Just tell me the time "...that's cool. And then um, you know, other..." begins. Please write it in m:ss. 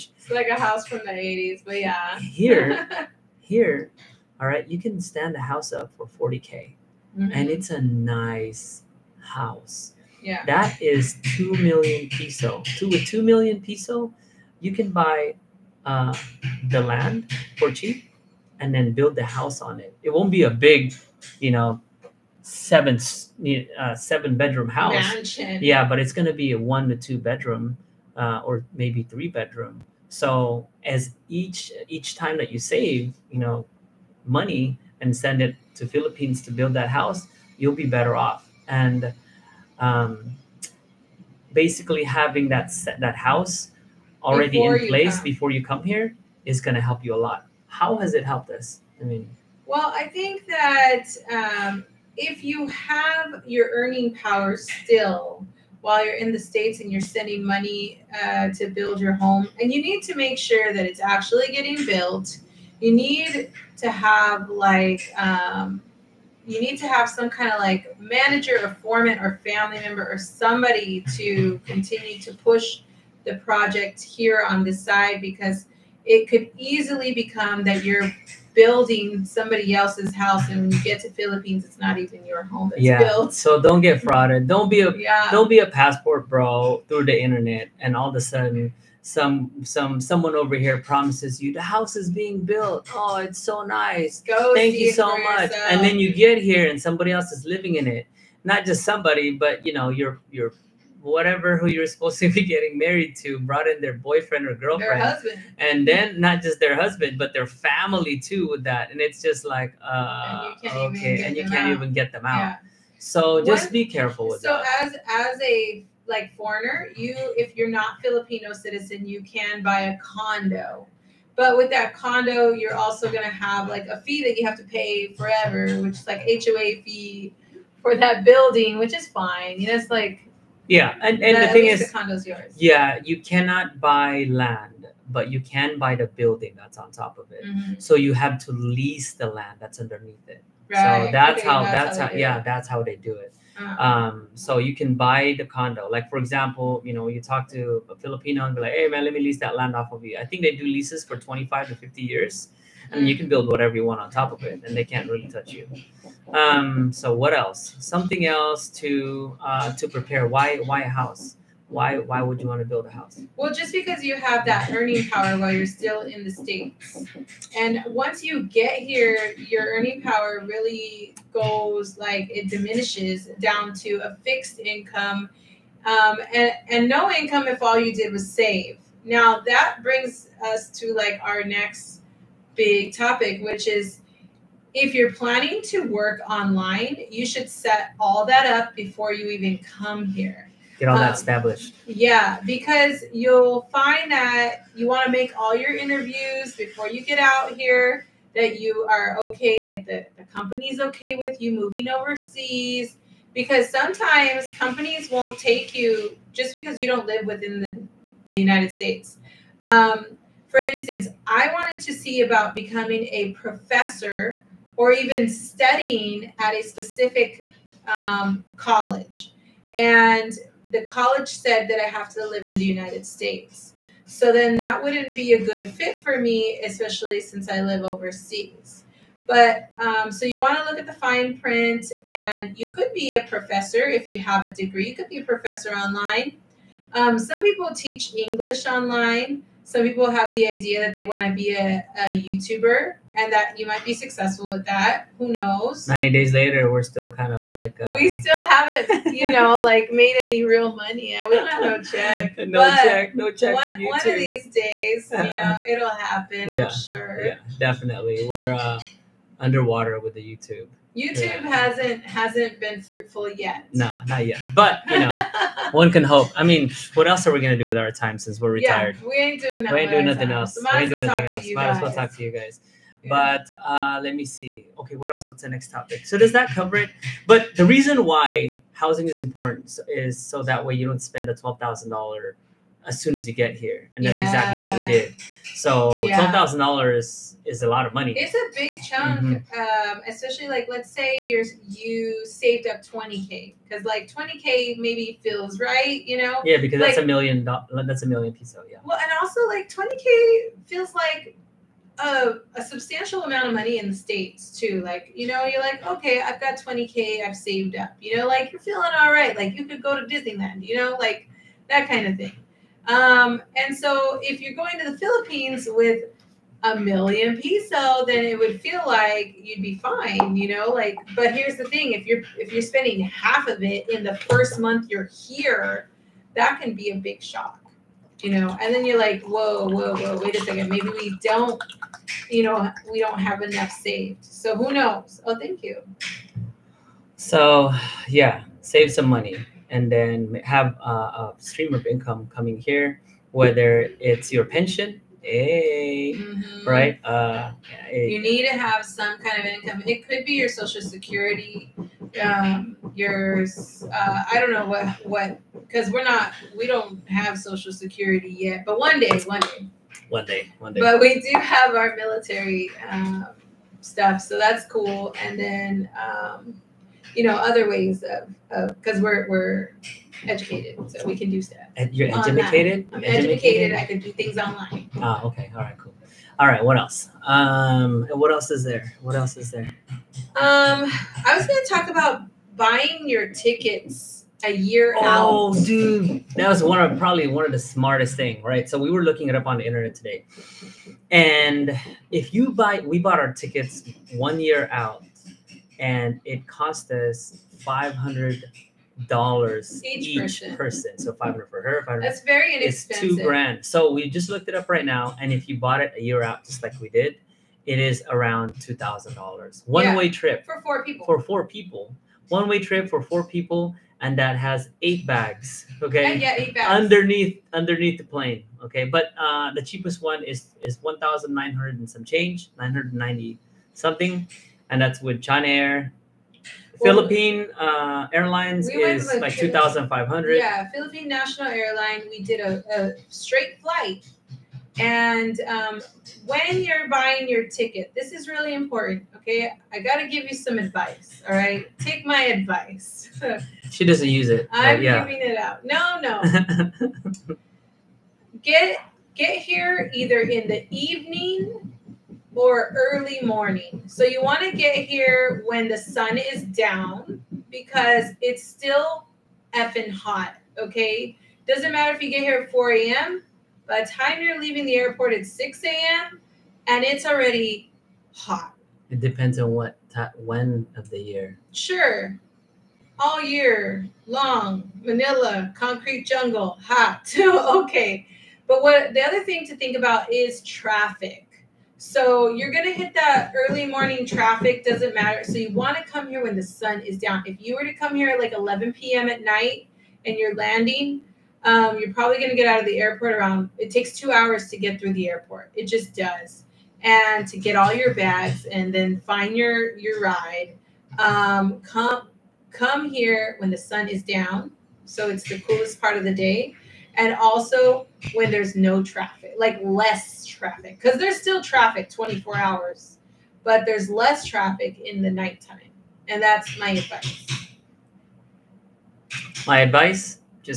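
6:04.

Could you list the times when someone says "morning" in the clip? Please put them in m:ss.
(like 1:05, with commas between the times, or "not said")
7:33, 8:03.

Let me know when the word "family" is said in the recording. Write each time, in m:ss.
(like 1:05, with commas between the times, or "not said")
1:09, 1:47.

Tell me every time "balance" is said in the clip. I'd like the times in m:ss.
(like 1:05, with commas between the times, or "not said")
not said.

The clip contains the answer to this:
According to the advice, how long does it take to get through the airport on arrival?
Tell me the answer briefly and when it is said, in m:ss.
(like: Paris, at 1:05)
2 hours, at 8:13.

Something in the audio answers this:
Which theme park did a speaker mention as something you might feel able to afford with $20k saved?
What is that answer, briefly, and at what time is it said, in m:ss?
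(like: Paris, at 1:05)
Disneyland, at 5:10.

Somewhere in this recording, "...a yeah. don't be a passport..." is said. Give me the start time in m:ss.
1:24.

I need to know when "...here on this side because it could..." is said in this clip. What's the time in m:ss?
1:14.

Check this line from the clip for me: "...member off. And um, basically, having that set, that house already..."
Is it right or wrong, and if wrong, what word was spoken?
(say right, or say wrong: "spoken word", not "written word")
wrong: "better", not "member".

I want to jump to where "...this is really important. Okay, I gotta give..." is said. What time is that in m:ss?
7:17.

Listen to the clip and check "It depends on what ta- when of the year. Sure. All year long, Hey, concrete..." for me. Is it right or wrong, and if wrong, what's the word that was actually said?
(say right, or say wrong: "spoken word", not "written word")
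wrong: "Manila", not "Hey".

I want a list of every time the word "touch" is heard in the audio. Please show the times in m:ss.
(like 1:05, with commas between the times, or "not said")
2:35.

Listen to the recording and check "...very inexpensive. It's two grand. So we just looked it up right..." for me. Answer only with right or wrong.
right.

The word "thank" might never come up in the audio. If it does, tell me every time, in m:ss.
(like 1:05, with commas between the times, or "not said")
1:34, 5:35.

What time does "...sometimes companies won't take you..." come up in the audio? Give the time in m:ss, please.
3:23.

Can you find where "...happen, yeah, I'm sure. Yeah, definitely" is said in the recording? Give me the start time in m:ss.
4:15.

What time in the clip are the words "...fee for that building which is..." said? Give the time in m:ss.
2:06.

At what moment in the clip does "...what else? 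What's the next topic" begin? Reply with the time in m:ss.
4:34.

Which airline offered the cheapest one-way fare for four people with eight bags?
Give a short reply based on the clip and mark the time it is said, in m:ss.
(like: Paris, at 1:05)
China Air, at 7:05.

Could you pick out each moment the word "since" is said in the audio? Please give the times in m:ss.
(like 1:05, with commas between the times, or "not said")
3:47, 4:28.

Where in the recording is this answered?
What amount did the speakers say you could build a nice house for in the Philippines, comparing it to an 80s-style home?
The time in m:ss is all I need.
0:06.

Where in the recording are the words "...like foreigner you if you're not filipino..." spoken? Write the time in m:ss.
1:56.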